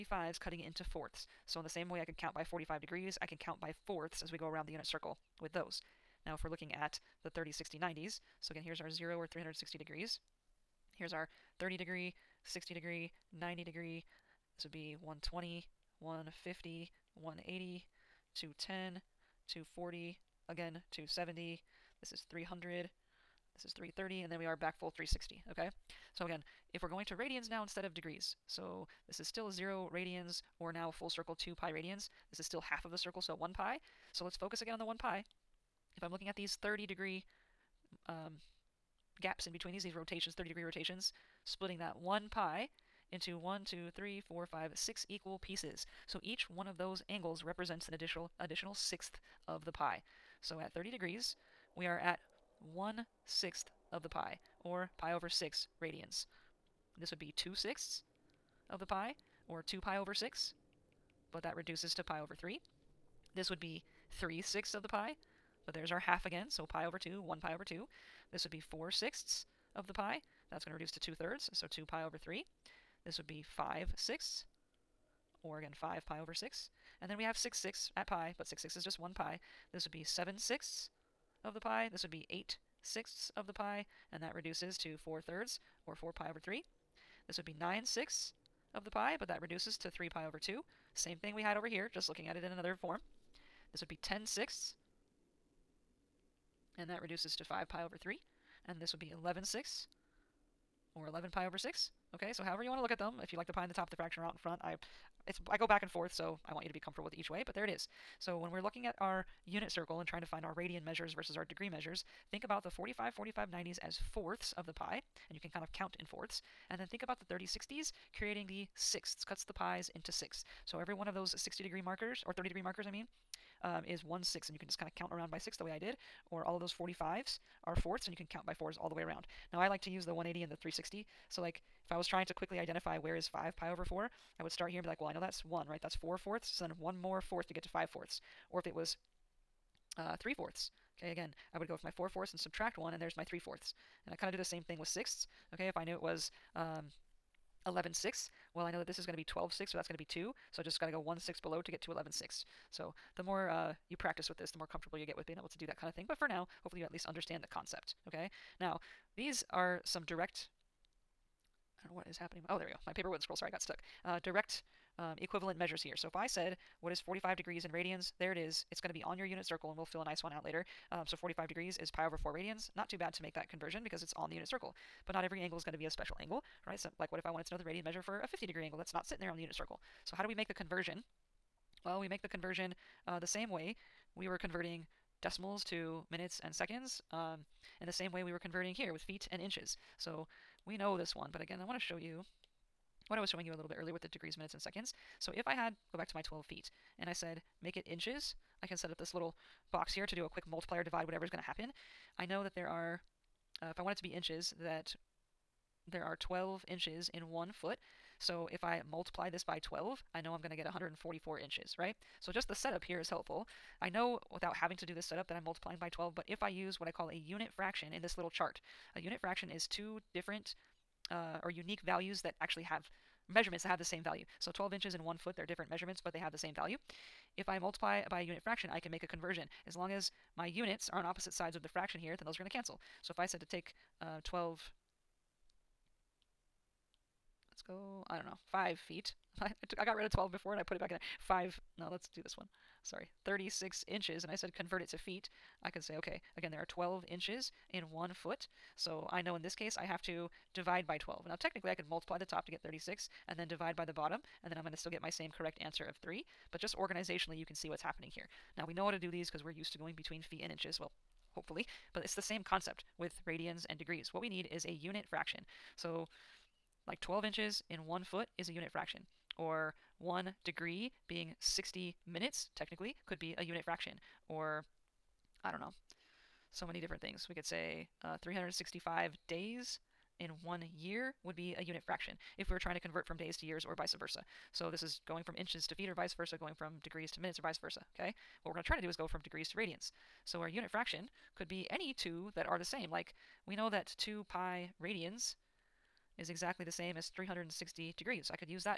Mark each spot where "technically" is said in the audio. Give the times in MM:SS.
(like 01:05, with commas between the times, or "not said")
04:11, 04:32.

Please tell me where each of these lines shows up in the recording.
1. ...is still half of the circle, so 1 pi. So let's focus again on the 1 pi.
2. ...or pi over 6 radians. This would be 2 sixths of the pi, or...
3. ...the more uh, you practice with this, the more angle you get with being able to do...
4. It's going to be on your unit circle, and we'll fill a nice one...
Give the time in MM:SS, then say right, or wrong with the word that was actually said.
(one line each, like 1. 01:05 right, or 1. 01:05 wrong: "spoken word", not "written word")
1. 00:32 right
2. 00:54 right
3. 02:33 wrong: "comfortable", not "angle"
4. 02:48 right.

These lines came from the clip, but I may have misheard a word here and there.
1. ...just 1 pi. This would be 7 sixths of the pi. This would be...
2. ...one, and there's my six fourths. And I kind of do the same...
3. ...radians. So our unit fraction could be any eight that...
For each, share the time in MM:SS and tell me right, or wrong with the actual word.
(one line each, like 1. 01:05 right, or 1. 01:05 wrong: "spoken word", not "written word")
1. 01:18 right
2. 02:22 wrong: "three", not "six"
3. 04:49 wrong: "two", not "eight".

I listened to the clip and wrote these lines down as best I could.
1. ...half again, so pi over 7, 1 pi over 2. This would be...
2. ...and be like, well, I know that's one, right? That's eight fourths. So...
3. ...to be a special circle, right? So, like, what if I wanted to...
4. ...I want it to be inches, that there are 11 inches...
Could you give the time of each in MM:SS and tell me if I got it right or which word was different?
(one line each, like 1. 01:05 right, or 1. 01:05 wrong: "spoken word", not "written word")
1. 01:05 wrong: "2", not "7"
2. 02:14 wrong: "four", not "eight"
3. 02:55 wrong: "angle", not "circle"
4. 03:23 wrong: "12", not "11".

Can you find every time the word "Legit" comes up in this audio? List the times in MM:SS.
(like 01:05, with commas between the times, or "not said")
not said.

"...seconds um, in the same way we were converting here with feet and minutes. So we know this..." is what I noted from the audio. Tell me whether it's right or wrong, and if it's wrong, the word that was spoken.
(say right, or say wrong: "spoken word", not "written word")
wrong: "inches", not "minutes".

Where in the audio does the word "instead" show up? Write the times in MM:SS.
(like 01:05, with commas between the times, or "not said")
00:27.